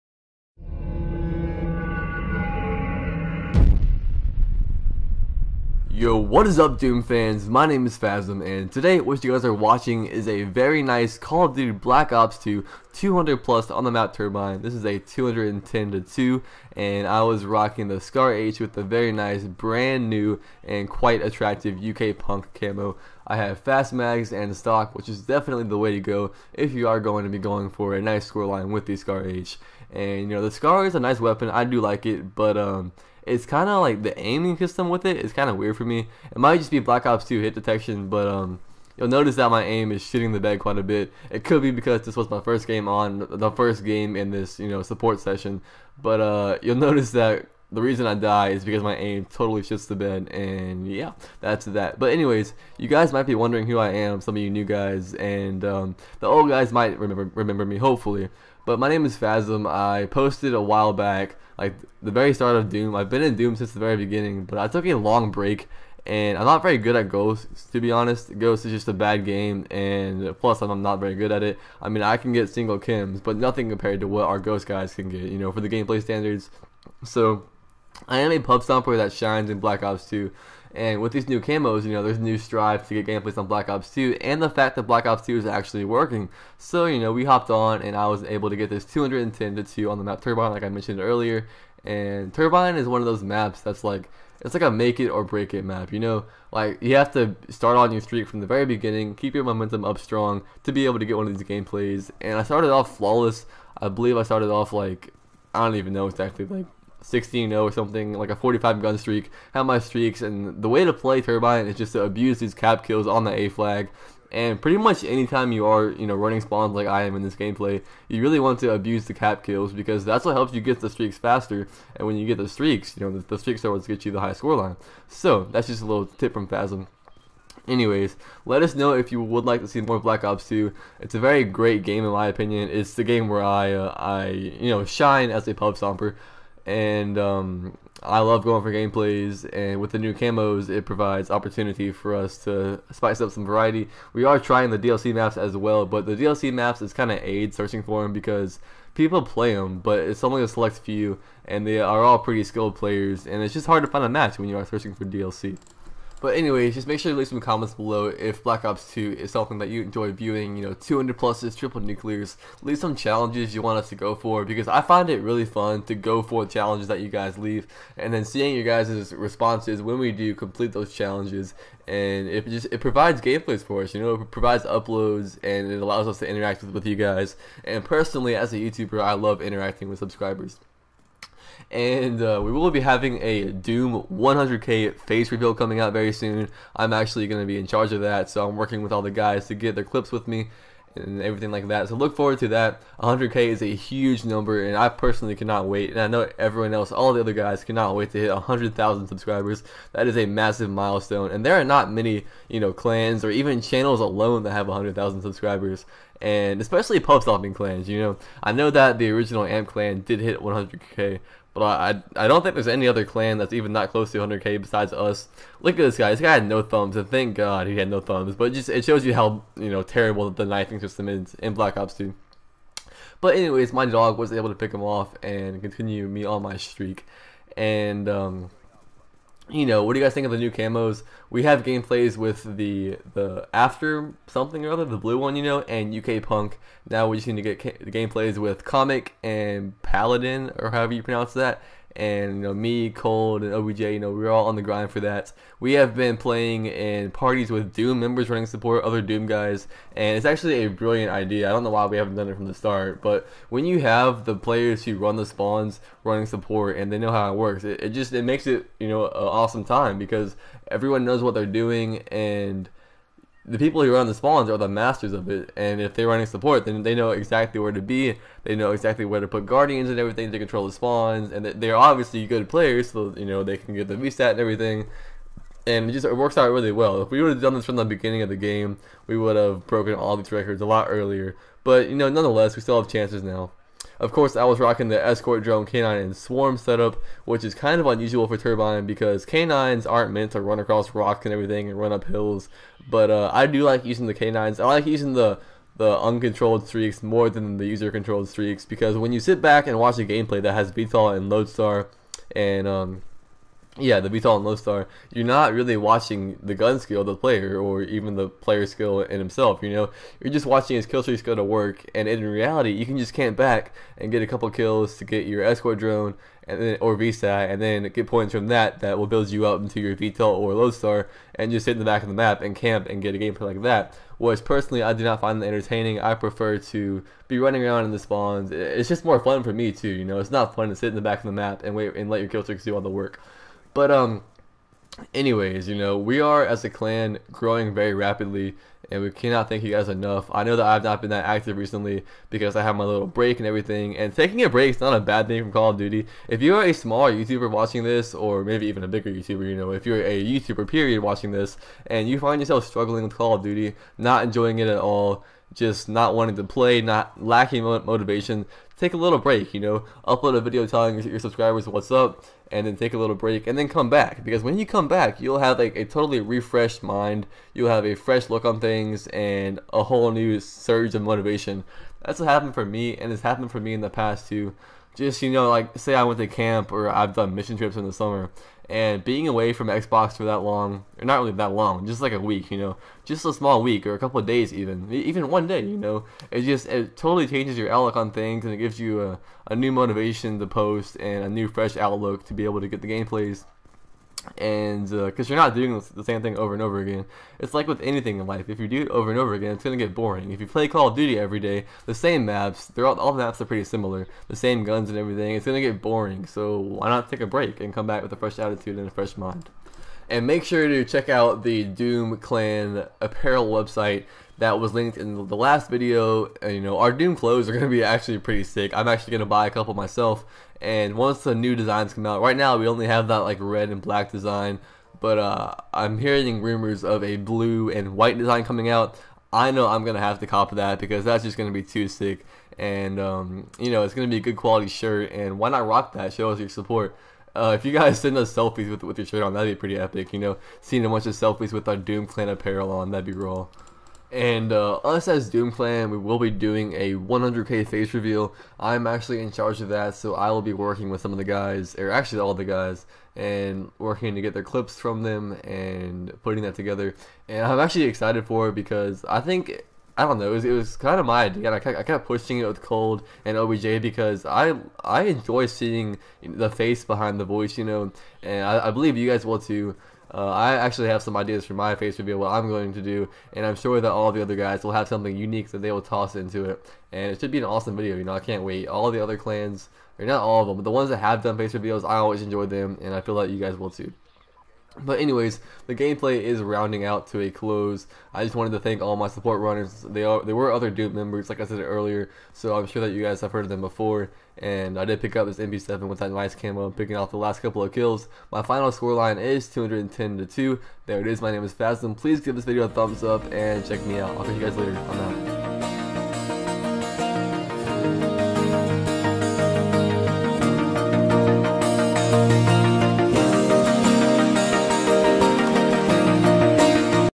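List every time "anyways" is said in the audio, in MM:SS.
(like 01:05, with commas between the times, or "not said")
00:52, 02:07, 02:36, 03:43, 05:35, 08:04.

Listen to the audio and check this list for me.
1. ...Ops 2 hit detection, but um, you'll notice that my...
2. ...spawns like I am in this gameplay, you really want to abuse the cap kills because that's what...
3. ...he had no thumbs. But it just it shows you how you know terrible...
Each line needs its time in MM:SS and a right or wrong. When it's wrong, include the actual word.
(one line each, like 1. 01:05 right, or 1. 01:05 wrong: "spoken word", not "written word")
1. 00:37 right
2. 01:56 right
3. 03:37 right.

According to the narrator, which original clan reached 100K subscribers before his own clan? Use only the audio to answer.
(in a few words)
Amp.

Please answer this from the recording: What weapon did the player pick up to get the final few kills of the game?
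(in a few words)
MP7.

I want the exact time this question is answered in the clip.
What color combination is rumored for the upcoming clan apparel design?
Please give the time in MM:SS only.
07:07.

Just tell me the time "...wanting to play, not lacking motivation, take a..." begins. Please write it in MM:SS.
05:56.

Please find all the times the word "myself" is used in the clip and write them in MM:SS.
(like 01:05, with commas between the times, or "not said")
06:59.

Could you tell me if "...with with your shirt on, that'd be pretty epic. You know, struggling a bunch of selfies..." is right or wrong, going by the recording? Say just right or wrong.
wrong.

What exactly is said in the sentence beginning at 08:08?
I just wanted to thank all my support runners.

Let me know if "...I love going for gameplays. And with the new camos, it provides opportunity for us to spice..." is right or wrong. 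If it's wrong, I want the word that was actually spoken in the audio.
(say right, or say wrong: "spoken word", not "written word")
right.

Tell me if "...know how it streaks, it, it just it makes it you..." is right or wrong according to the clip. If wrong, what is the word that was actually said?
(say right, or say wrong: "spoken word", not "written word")
wrong: "works", not "streaks".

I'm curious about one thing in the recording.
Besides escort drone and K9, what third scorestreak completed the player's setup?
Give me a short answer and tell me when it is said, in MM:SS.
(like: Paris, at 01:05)
Swarm, at 04:46.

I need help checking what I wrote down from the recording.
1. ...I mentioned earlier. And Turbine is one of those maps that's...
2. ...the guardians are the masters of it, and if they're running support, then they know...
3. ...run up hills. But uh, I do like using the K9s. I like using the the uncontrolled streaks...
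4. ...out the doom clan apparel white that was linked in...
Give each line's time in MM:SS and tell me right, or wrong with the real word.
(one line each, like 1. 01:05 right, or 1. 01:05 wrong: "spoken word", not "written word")
1. 01:30 right
2. 04:24 wrong: "spawns", not "guardians"
3. 04:51 right
4. 06:51 wrong: "website", not "white".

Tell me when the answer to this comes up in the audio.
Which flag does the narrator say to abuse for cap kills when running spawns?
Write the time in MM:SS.
01:53.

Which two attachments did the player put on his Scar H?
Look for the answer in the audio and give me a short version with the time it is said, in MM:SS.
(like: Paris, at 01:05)
Fast mags and stock, at 00:23.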